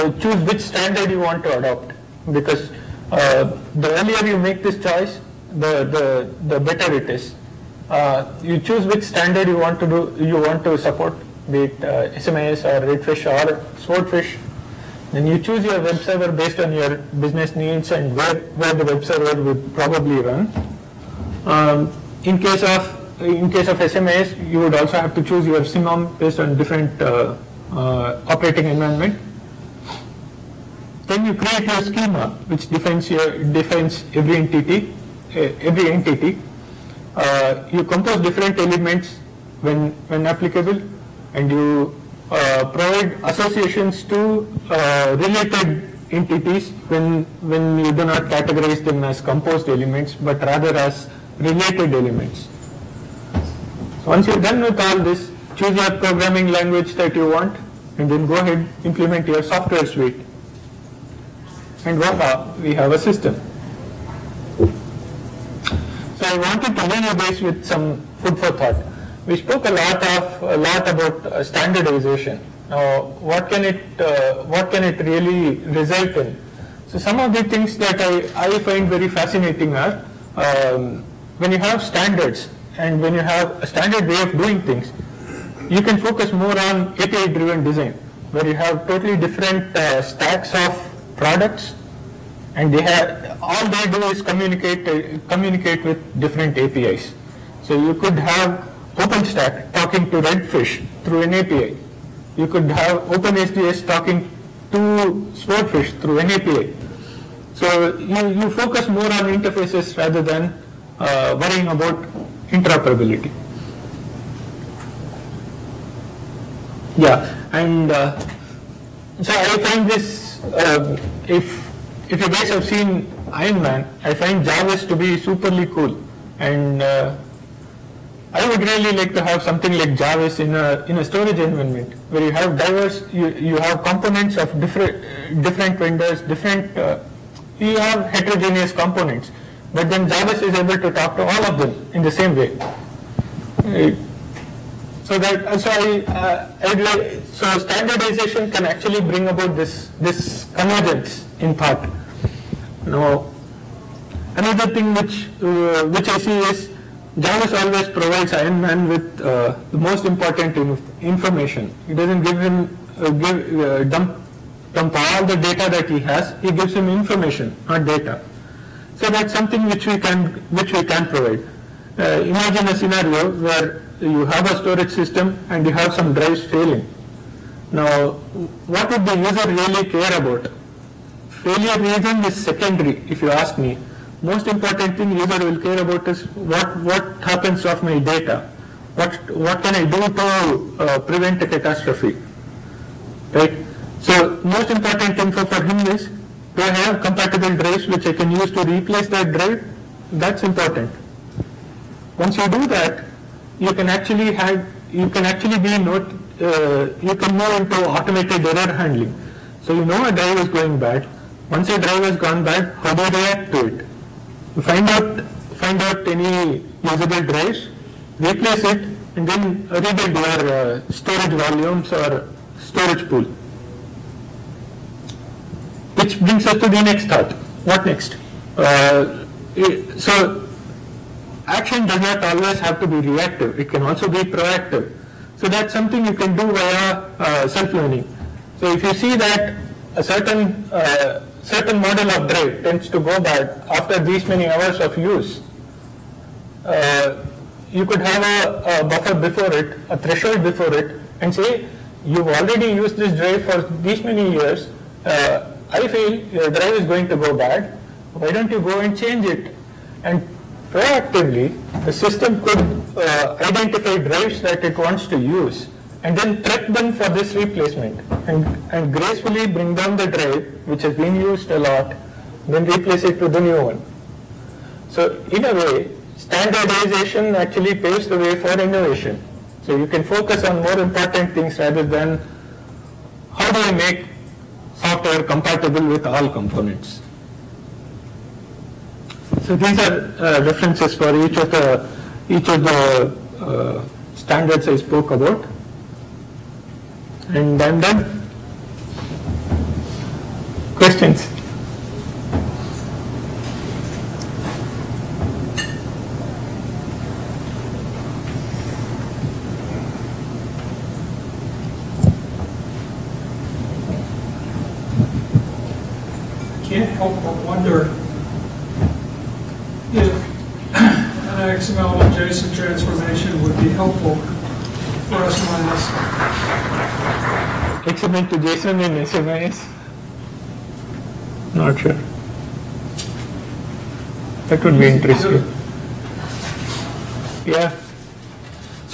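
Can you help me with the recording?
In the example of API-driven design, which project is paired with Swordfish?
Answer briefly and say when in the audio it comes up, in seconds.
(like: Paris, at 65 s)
OpenSDS, at 103 s.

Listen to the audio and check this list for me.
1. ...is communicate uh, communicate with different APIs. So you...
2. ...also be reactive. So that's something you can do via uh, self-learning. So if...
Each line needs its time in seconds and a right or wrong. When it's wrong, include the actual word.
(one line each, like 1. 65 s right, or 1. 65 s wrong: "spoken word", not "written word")
1. 94 s right
2. 233 s wrong: "proactive", not "reactive".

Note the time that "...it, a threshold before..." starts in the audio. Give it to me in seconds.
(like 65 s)
249 s.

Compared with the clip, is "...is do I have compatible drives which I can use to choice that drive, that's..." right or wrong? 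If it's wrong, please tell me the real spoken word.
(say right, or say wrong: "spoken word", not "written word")
wrong: "replace", not "choice".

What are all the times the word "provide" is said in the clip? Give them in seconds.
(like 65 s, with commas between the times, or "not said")
42 s, 157 s, 171 s.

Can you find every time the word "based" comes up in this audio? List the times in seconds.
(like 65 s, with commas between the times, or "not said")
16 s, 26 s.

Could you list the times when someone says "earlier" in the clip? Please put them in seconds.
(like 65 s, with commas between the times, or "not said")
3 s.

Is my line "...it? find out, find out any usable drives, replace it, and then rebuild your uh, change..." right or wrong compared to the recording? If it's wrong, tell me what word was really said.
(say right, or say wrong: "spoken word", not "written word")
wrong: "storage", not "change".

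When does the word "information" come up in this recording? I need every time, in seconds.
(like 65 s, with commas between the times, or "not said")
161 s, 166 s.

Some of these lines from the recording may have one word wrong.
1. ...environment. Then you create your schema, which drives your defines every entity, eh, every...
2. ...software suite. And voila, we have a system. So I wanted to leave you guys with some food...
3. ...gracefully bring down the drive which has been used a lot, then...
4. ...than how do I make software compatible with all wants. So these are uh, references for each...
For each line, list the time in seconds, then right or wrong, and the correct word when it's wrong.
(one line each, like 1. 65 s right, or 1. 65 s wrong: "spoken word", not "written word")
1. 28 s wrong: "defines", not "drives"
2. 59 s right
3. 268 s right
4. 281 s wrong: "components", not "wants".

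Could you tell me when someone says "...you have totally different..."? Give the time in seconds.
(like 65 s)
88 s.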